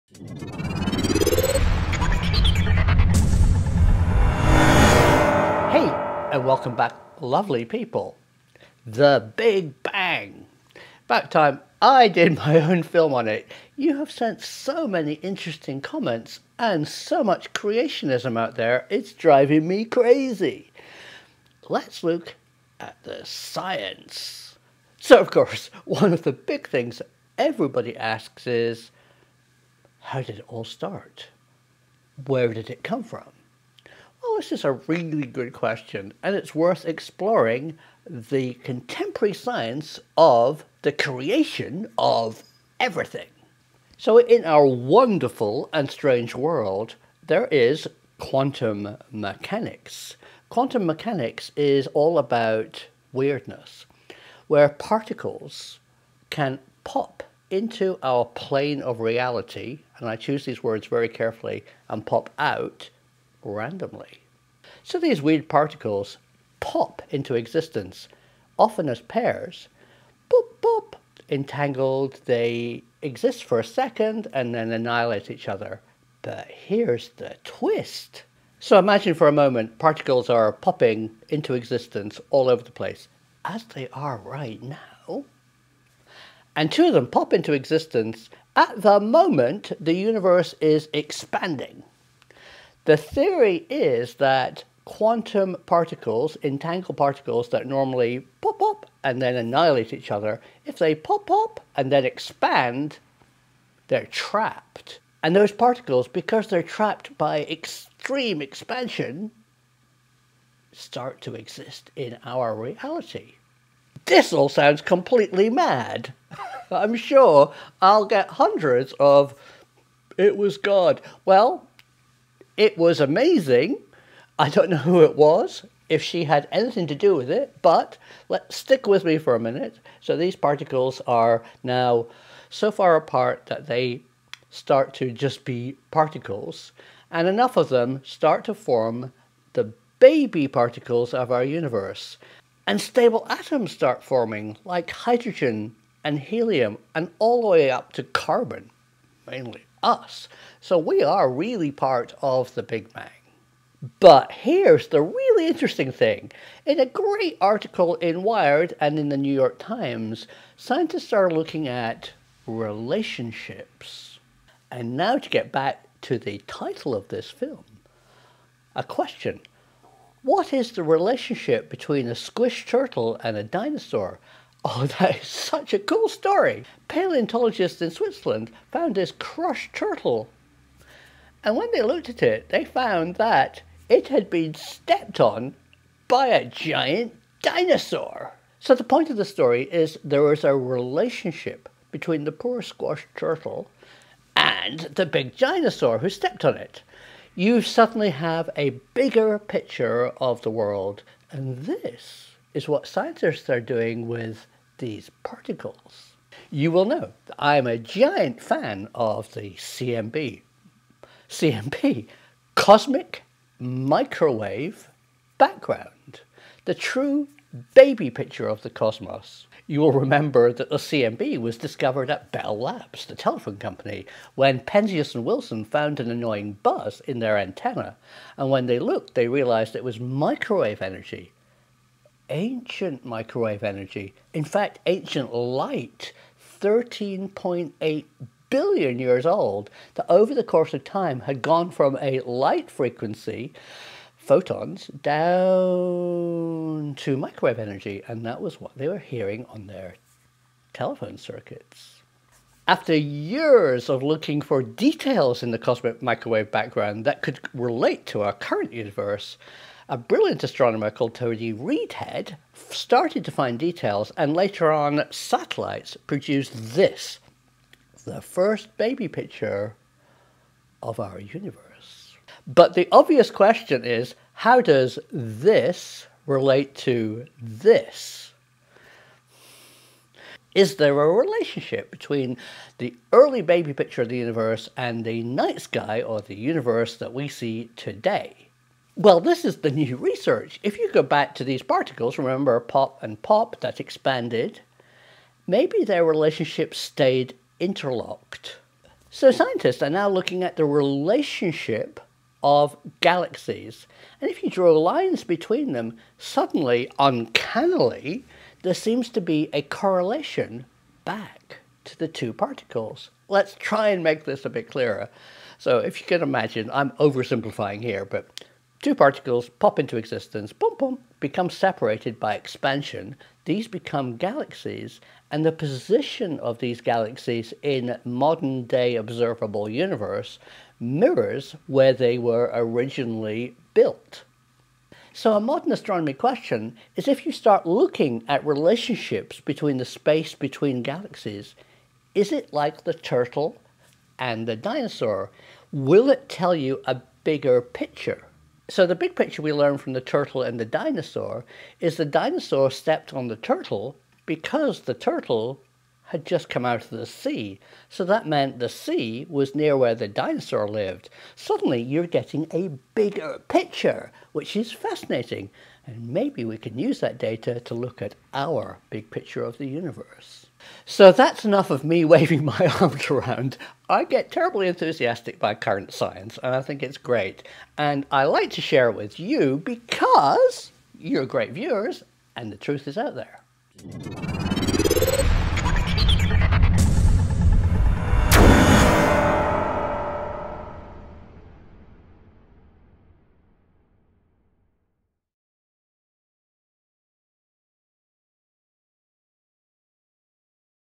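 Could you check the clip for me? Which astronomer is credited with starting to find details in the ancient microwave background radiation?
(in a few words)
Tony Readhead.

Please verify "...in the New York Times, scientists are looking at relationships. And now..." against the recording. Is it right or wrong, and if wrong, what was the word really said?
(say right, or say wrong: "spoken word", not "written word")
right.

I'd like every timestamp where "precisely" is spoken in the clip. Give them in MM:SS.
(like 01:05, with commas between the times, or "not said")
not said.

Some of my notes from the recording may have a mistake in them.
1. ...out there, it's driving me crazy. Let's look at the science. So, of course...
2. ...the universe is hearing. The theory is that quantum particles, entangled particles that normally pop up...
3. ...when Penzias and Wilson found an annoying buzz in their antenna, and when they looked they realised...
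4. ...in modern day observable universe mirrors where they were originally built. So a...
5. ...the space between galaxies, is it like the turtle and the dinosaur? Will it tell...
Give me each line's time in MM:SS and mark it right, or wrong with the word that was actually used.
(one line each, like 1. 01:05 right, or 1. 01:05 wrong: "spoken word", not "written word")
1. 00:18 right
2. 01:29 wrong: "expanding", not "hearing"
3. 03:44 right
4. 05:27 right
5. 05:39 right.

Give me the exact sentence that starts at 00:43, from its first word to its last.
So, in our wonderful and strange world, there is quantum mechanics.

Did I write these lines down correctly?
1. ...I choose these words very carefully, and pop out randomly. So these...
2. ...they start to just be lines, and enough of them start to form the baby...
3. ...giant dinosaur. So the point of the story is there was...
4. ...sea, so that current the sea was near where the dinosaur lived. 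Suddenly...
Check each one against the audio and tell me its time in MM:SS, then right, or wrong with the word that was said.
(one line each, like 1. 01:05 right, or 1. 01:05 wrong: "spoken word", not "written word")
1. 01:00 right
2. 02:13 wrong: "particles", not "lines"
3. 03:06 right
4. 05:57 wrong: "meant", not "current".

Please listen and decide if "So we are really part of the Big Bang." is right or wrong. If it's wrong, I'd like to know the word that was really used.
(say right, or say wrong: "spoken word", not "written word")
right.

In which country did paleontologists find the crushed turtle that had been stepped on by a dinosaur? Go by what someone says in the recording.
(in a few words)
Switzerland.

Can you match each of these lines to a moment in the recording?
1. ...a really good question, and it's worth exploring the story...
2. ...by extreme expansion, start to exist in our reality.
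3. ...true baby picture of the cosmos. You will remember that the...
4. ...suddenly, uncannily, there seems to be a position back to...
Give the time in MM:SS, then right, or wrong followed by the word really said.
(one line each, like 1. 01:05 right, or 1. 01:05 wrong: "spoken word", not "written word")
1. 00:34 wrong: "contemporary", not "story"
2. 01:47 right
3. 03:36 right
4. 05:06 wrong: "correlation", not "position".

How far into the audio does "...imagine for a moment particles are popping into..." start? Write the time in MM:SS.
01:18.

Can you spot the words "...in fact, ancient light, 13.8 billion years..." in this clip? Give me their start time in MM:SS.
03:54.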